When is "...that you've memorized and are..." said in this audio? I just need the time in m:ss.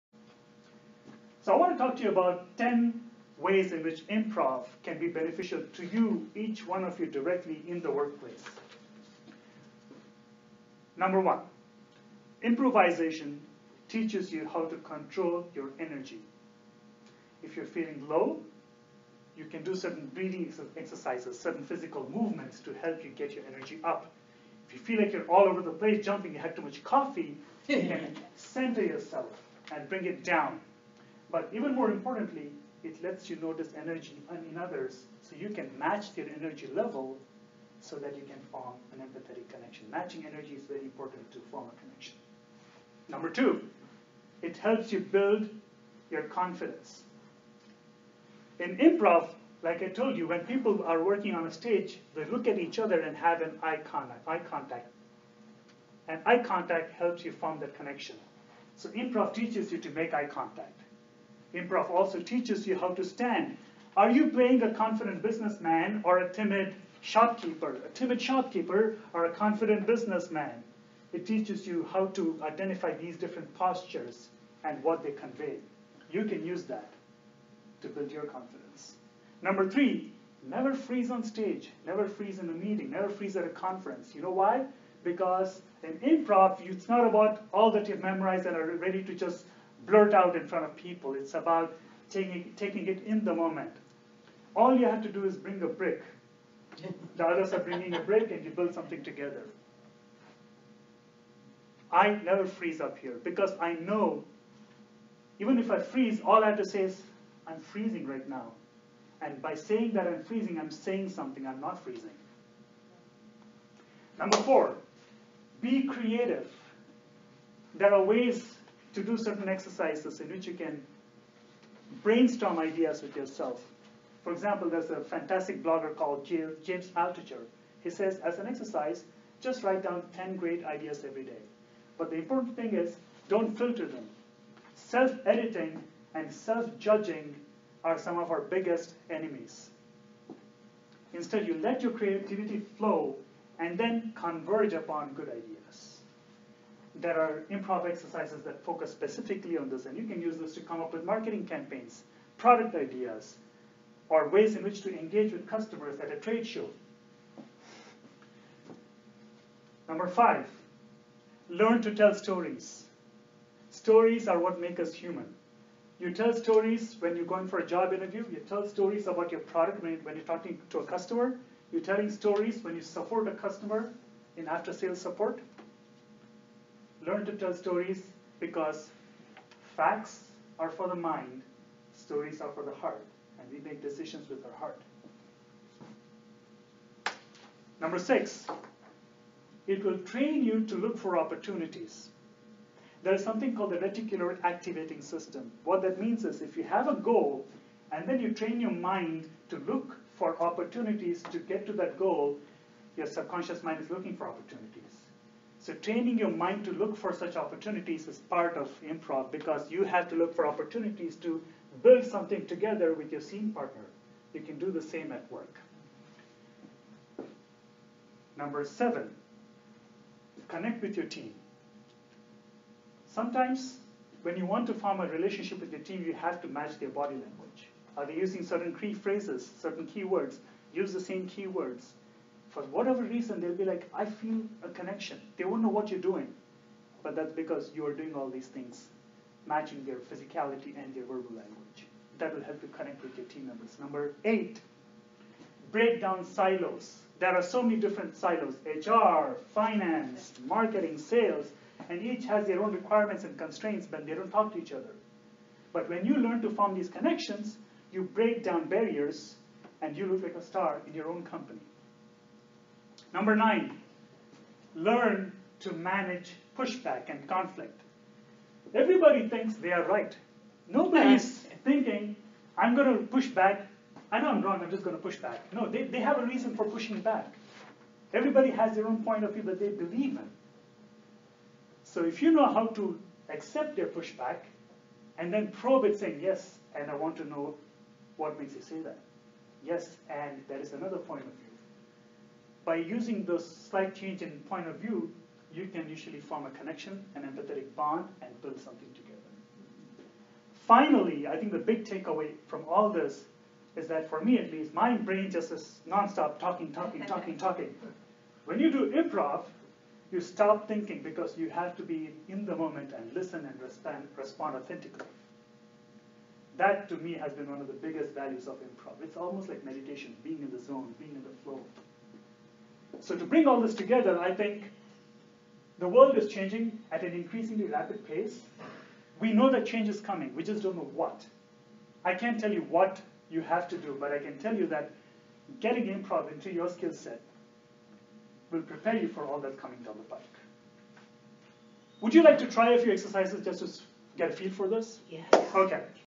1:27.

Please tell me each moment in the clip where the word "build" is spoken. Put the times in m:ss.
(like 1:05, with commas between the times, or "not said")
0:44, 1:17, 1:38, 3:31, 4:58.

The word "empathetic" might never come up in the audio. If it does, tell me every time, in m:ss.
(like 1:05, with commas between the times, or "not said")
0:38, 4:57.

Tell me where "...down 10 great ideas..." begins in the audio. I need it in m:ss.
2:09.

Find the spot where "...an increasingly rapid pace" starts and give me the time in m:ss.
5:27.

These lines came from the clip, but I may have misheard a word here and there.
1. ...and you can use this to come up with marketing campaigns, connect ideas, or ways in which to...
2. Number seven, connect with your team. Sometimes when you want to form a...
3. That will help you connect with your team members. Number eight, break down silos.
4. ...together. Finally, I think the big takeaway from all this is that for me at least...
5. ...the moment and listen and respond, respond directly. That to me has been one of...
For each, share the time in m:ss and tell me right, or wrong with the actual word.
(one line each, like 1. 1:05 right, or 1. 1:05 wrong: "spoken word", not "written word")
1. 2:29 wrong: "product", not "connect"
2. 3:38 right
3. 4:02 right
4. 4:58 right
5. 5:12 wrong: "authentically", not "directly".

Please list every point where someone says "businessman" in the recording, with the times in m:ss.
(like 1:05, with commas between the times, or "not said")
1:05, 1:09.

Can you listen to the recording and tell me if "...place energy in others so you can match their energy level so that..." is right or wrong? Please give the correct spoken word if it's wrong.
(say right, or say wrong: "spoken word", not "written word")
wrong: "notice", not "place".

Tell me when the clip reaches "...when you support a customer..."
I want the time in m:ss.
2:52.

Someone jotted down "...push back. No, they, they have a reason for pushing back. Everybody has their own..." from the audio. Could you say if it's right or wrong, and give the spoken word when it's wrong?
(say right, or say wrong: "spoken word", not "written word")
right.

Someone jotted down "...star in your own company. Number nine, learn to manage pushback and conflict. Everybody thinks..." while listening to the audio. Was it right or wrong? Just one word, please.
right.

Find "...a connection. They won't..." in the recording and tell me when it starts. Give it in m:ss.
3:54.